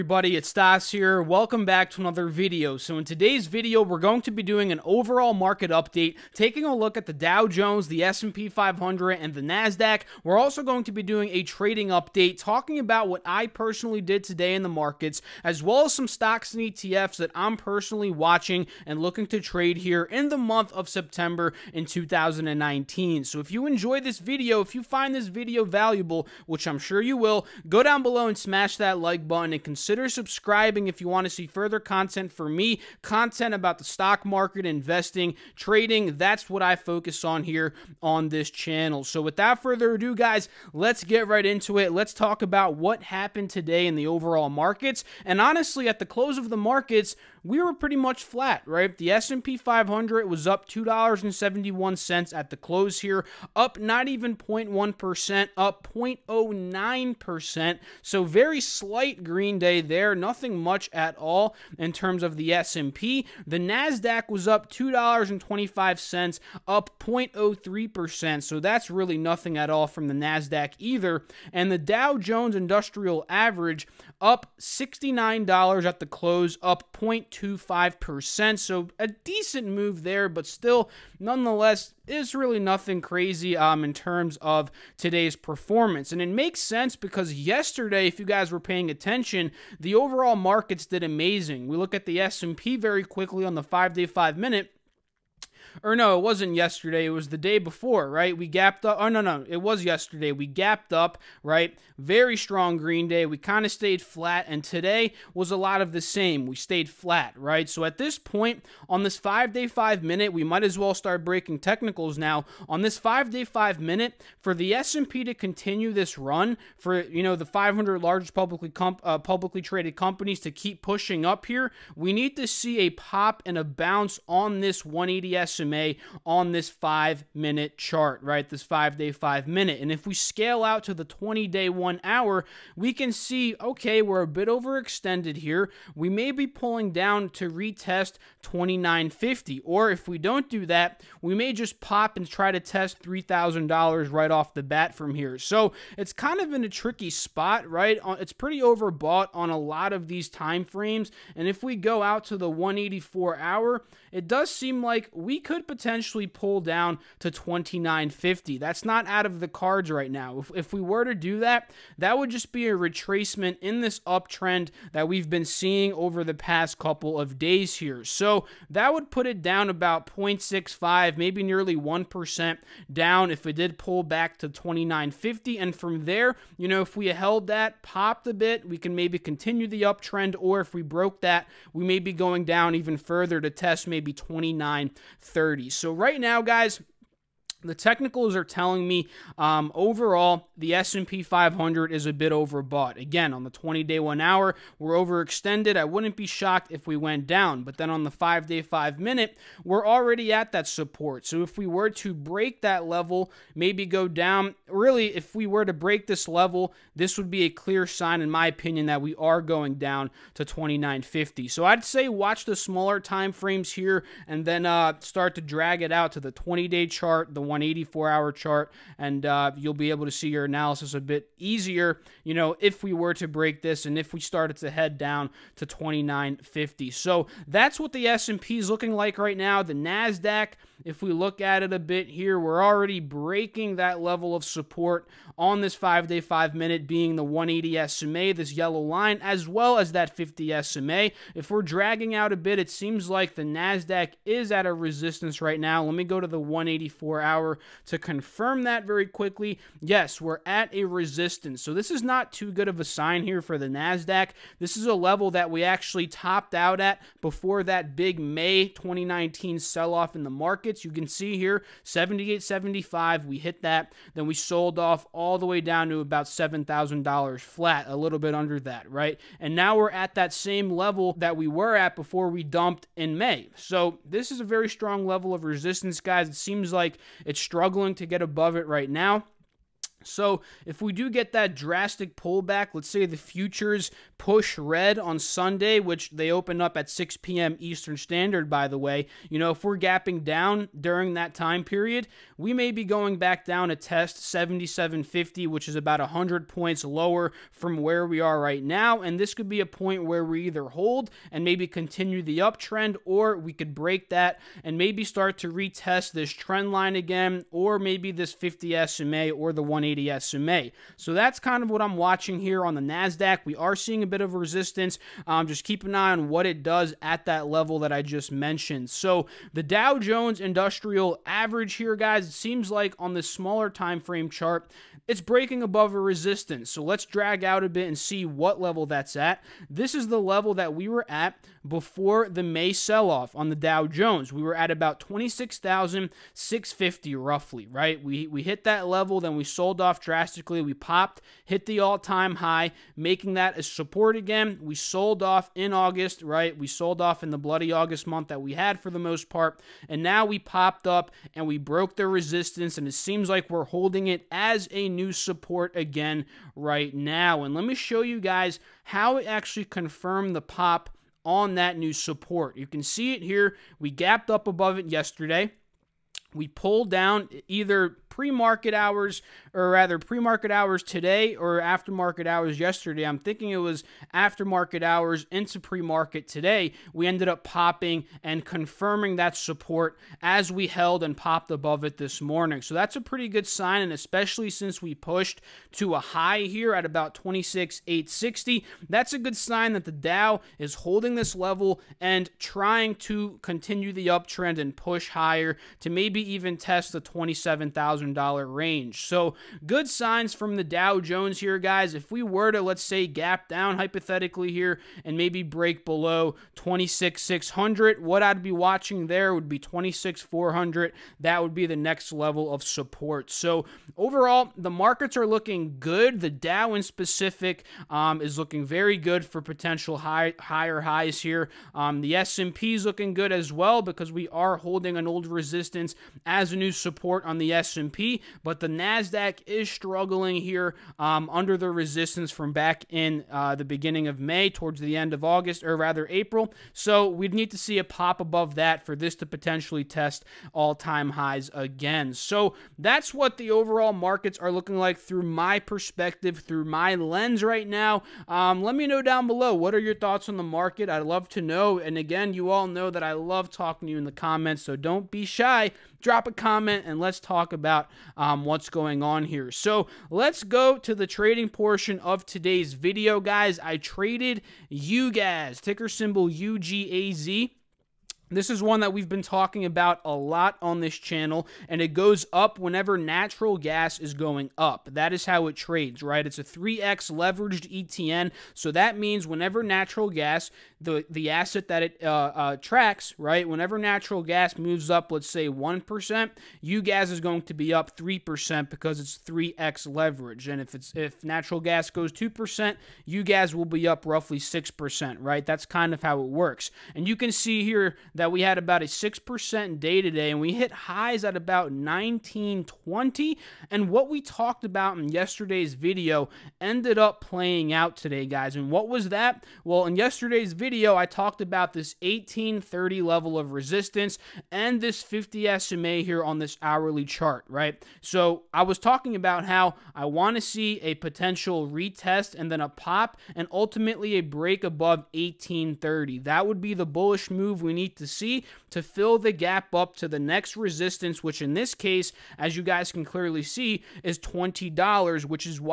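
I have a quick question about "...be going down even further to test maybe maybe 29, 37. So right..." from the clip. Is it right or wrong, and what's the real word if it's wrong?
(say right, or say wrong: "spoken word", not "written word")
wrong: "30", not "37".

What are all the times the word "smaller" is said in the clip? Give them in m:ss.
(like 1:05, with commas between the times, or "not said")
3:32, 5:23.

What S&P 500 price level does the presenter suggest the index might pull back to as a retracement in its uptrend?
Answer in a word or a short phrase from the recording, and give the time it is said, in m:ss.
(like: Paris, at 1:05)
2950, at 2:17.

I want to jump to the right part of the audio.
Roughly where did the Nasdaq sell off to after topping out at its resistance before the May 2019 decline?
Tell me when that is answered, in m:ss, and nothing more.
4:26.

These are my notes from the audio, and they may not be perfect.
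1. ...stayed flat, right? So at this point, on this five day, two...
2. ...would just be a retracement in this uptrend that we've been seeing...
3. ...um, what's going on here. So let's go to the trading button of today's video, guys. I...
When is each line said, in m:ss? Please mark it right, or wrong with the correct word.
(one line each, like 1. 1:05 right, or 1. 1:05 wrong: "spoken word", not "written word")
1. 1:46 wrong: "five", not "two"
2. 2:42 right
3. 7:38 wrong: "portion", not "button".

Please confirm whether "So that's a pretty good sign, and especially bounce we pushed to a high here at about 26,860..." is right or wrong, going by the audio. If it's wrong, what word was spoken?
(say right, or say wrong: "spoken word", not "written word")
wrong: "since", not "bounce".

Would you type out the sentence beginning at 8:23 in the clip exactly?
And what we talked about in yesterday's video ended up playing out today, guys.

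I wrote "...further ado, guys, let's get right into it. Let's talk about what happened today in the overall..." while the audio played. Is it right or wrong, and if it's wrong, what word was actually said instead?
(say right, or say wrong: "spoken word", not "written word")
right.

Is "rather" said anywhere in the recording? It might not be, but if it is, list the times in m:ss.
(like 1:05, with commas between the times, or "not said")
6:09, 7:15.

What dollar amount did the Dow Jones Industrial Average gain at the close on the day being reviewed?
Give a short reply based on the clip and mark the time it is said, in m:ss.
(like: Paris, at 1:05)
$69, at 1:14.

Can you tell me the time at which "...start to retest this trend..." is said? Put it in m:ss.
5:05.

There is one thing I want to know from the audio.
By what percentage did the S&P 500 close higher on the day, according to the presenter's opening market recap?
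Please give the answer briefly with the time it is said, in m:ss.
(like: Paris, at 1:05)
0.09%, at 0:55.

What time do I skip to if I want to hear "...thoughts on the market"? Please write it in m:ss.
7:29.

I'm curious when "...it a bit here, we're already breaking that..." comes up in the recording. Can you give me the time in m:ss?
3:51.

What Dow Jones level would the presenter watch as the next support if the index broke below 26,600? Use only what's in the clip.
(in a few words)
26,400.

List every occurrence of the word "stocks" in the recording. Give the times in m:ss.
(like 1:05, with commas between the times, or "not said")
0:16, 0:33.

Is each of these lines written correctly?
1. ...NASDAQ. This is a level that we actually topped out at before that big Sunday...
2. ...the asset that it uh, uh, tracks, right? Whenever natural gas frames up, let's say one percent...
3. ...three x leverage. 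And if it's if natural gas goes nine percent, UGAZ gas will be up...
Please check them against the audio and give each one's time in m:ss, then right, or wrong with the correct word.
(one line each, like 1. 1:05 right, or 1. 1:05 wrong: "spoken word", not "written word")
1. 4:13 wrong: "May", not "Sunday"
2. 8:01 wrong: "moves", not "frames"
3. 8:09 wrong: "two", not "nine".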